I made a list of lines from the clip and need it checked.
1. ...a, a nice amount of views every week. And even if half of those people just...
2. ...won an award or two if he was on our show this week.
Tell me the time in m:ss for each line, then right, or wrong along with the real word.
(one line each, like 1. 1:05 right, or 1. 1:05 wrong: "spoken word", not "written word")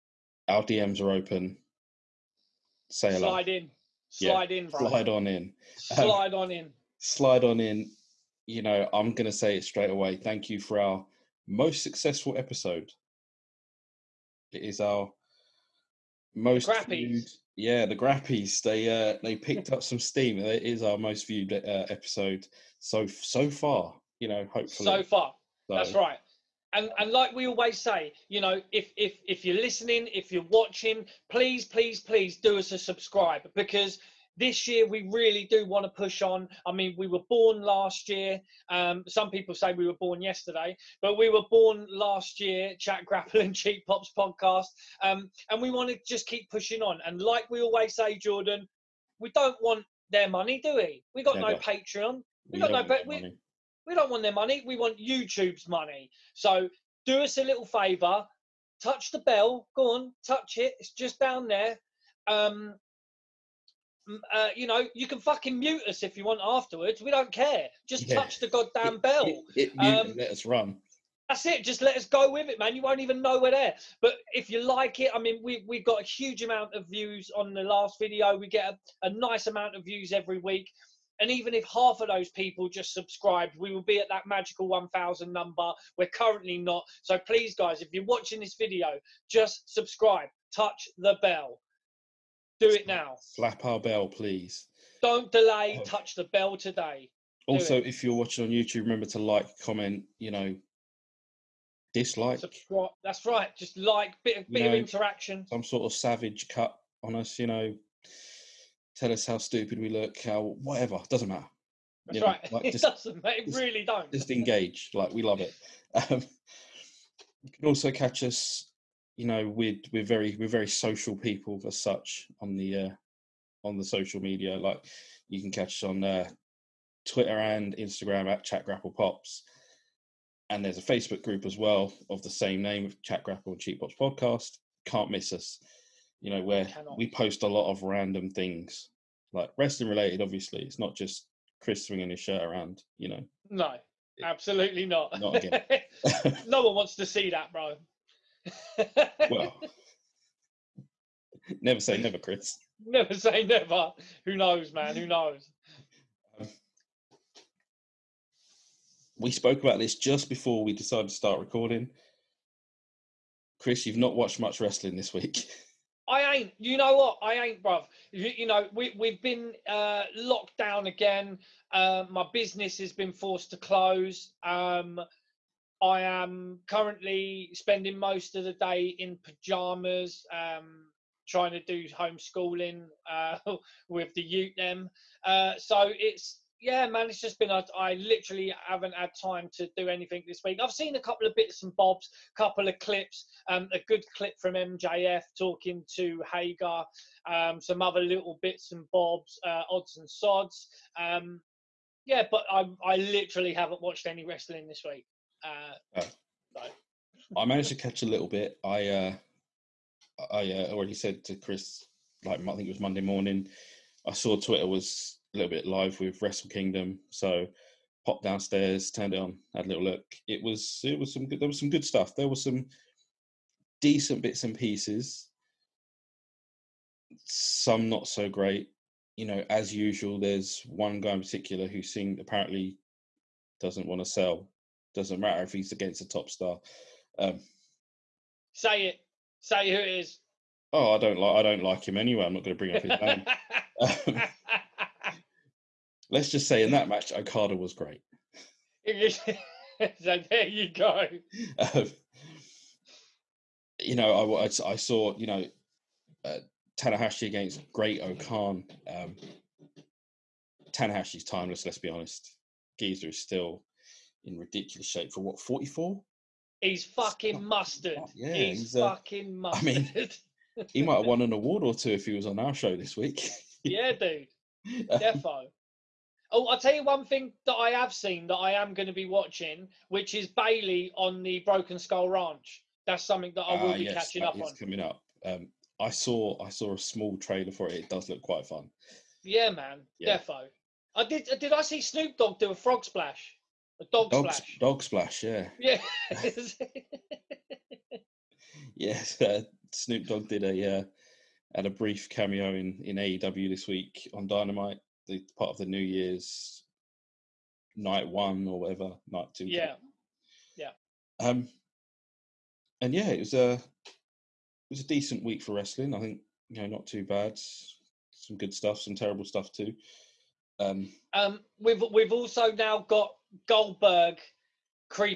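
1. 1:19 right
2. 4:31 right.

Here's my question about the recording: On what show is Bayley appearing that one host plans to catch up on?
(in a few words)
Broken Skull Ranch.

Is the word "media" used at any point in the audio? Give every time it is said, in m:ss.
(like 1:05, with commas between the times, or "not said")
2:04.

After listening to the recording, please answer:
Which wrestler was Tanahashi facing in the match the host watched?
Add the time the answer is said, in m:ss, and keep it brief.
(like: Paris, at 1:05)
Great-O-Khan, at 4:17.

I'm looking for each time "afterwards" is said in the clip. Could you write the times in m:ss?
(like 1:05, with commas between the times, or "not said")
1:06.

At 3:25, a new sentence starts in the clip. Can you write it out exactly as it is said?
Uh, uh, I managed to catch a little bit.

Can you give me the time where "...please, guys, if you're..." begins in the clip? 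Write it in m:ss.
1:27.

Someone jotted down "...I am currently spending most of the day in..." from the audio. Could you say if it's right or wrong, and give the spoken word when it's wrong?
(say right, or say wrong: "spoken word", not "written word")
right.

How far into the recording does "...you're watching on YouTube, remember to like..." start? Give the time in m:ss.
1:38.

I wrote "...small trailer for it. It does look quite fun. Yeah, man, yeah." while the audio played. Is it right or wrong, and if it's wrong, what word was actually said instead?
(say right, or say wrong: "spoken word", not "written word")
right.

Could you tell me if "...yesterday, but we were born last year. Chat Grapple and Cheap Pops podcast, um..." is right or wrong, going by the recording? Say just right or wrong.
right.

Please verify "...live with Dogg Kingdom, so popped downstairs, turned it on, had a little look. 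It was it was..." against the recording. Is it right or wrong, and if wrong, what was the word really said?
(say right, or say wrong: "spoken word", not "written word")
wrong: "Wrestle", not "Dogg".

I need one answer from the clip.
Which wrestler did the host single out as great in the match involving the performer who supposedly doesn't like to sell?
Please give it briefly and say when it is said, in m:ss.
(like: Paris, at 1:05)
Okada, at 4:07.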